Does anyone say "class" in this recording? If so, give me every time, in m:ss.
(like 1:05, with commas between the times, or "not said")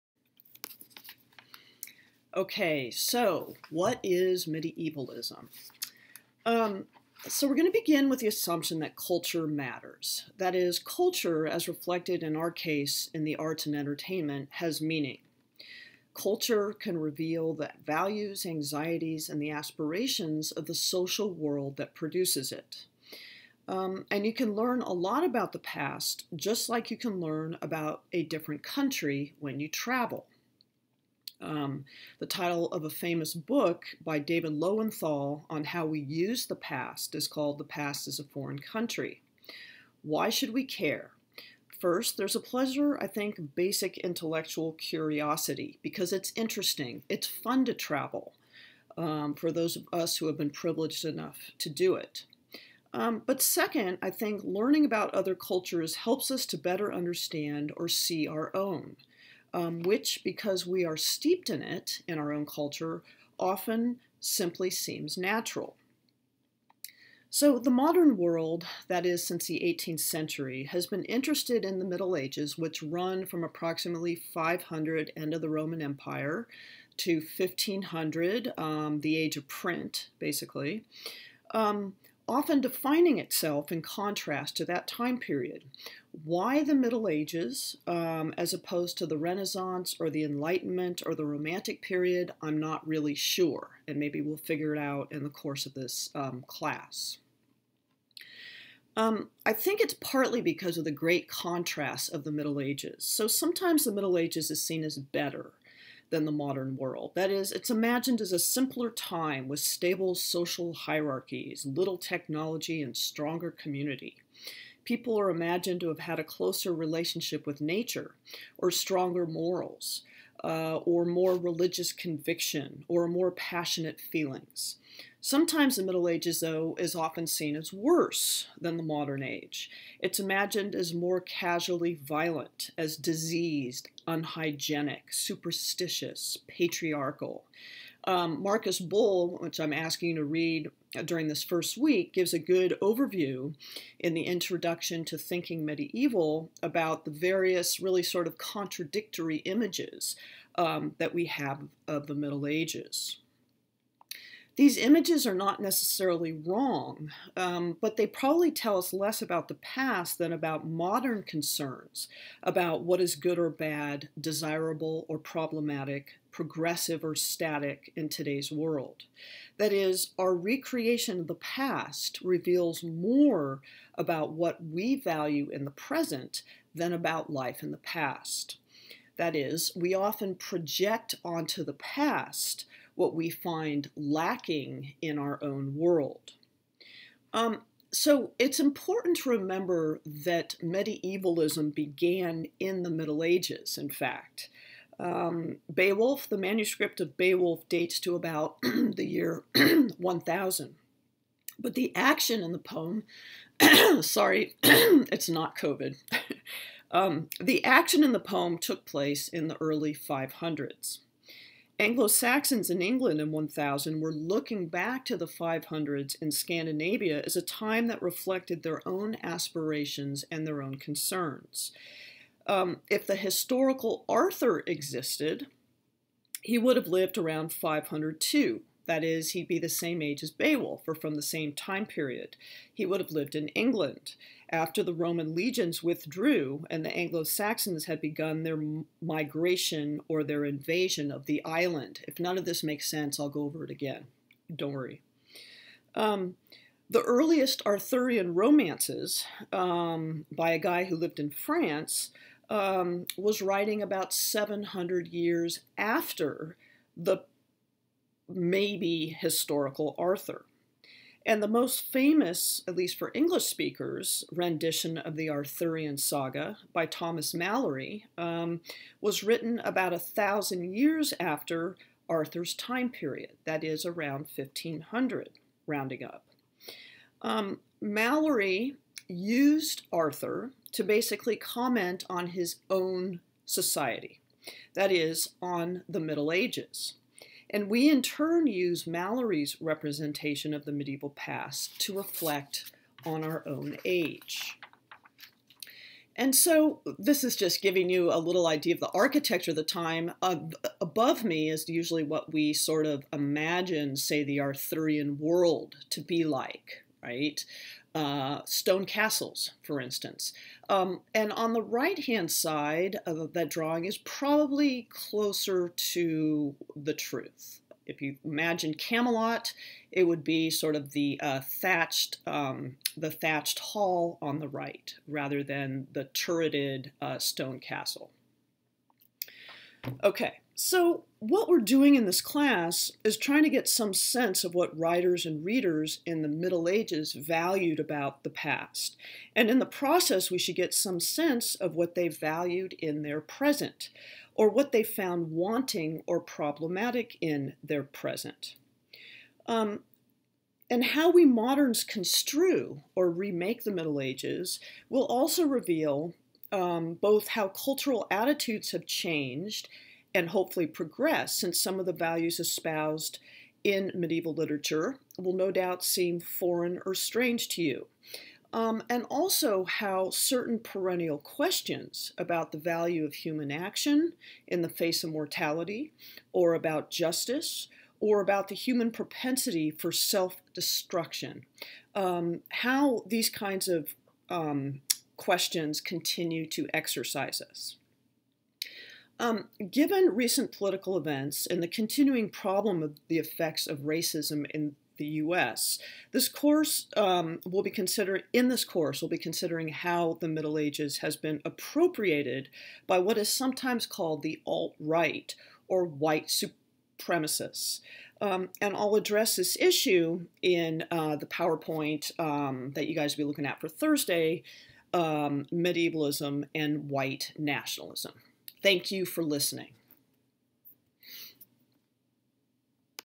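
1:36, 5:32.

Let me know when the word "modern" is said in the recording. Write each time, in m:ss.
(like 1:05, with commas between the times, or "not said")
1:07, 1:46, 2:08, 2:40, 5:51.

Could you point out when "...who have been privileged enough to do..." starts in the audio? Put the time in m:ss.
0:50.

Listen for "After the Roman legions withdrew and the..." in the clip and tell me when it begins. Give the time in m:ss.
3:54.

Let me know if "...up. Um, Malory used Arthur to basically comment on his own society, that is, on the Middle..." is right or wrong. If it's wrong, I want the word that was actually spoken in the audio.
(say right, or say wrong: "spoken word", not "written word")
right.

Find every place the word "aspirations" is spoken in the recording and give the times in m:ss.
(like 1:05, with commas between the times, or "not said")
0:19, 3:39.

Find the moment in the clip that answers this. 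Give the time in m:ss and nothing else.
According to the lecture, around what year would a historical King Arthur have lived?
3:47.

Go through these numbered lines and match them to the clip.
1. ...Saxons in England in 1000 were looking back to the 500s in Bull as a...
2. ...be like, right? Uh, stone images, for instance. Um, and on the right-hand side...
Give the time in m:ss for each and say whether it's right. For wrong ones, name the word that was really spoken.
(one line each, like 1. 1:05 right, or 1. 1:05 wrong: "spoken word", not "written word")
1. 3:32 wrong: "Scandinavia", not "Bull"
2. 5:06 wrong: "castles", not "images".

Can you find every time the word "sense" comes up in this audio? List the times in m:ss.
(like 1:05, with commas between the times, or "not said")
4:02, 5:33, 5:40.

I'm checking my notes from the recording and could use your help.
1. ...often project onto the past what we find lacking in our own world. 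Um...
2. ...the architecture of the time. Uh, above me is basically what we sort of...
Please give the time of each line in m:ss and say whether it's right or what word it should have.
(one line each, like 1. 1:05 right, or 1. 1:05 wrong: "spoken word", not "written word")
1. 2:59 right
2. 4:58 wrong: "usually", not "basically".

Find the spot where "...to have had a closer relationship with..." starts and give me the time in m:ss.
1:55.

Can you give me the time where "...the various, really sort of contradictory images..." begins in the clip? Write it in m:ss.
2:27.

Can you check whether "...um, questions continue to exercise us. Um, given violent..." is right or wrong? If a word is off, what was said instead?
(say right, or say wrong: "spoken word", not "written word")
wrong: "recent", not "violent".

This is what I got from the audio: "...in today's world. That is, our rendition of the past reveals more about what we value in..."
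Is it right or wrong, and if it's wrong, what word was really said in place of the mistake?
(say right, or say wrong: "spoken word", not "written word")
wrong: "recreation", not "rendition".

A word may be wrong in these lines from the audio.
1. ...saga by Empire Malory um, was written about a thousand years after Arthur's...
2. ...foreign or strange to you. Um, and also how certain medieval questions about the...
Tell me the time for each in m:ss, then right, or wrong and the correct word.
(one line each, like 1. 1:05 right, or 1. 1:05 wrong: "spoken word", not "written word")
1. 4:25 wrong: "Thomas", not "Empire"
2. 6:06 wrong: "perennial", not "medieval".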